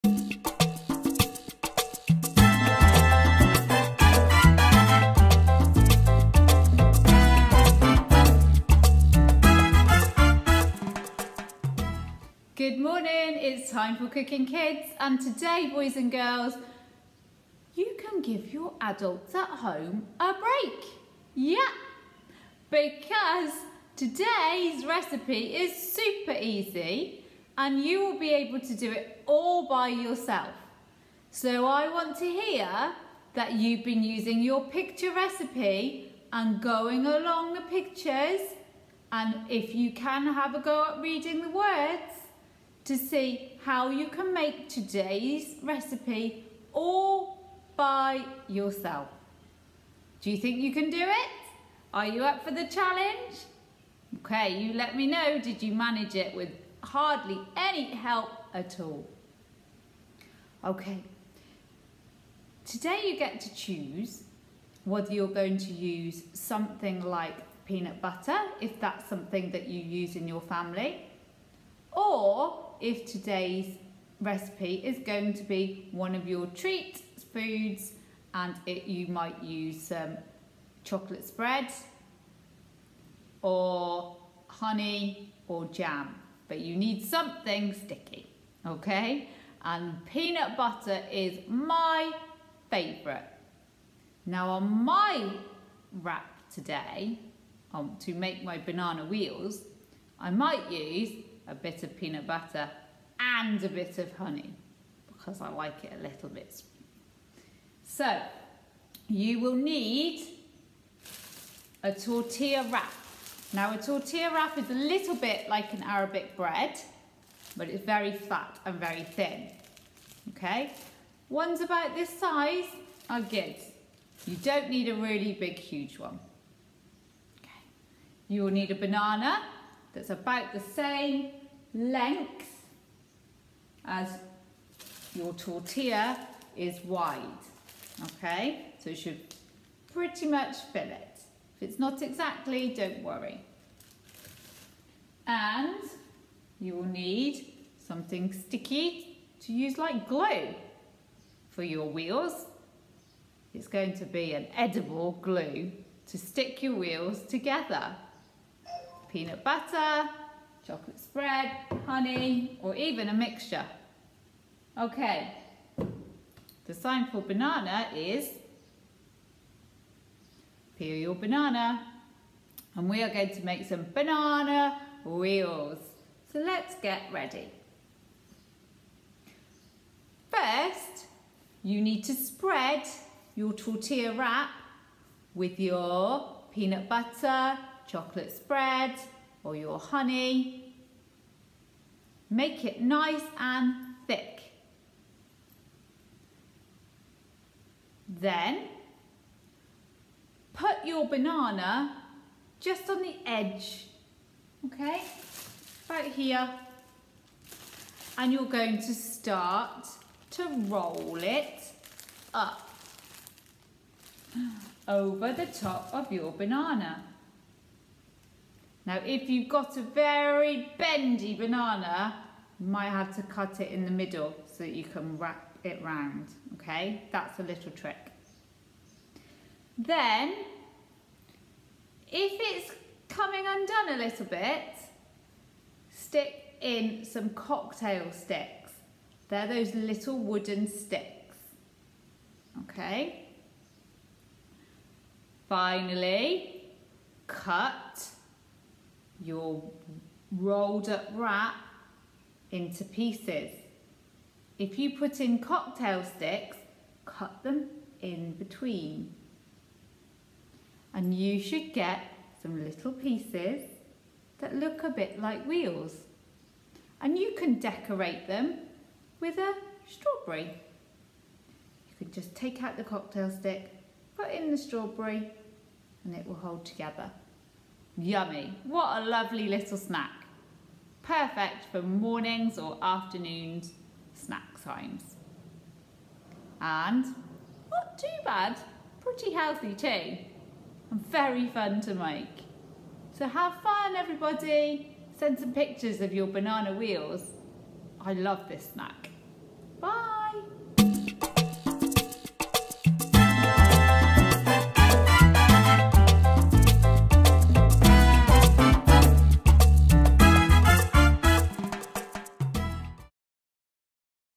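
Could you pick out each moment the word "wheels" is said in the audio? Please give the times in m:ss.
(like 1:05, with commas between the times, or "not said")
1:39, 2:31, 2:36, 2:55, 4:25, 4:56.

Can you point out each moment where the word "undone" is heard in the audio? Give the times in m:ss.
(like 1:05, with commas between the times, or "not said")
3:53.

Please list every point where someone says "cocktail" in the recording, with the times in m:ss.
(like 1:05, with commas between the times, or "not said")
3:57, 4:15, 4:32.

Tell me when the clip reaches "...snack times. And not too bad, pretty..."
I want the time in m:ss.
4:44.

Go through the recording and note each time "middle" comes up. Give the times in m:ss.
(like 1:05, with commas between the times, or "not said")
3:43.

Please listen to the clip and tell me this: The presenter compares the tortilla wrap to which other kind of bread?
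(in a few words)
Arabic bread.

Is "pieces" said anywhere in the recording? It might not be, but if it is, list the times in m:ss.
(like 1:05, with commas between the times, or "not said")
4:12, 4:22.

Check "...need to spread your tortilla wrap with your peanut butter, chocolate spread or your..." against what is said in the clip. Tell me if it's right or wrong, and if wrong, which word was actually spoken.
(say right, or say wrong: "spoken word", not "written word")
right.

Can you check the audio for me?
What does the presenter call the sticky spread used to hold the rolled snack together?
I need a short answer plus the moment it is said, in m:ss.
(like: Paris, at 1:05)
edible glue, at 2:34.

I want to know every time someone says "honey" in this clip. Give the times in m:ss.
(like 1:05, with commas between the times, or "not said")
1:24, 1:44, 2:41, 3:09.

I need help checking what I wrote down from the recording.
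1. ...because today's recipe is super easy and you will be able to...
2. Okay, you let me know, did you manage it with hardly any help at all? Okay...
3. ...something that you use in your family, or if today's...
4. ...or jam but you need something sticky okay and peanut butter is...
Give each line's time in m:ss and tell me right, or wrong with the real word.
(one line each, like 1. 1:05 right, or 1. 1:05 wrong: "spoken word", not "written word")
1. 0:22 right
2. 0:54 right
3. 1:09 right
4. 1:25 right.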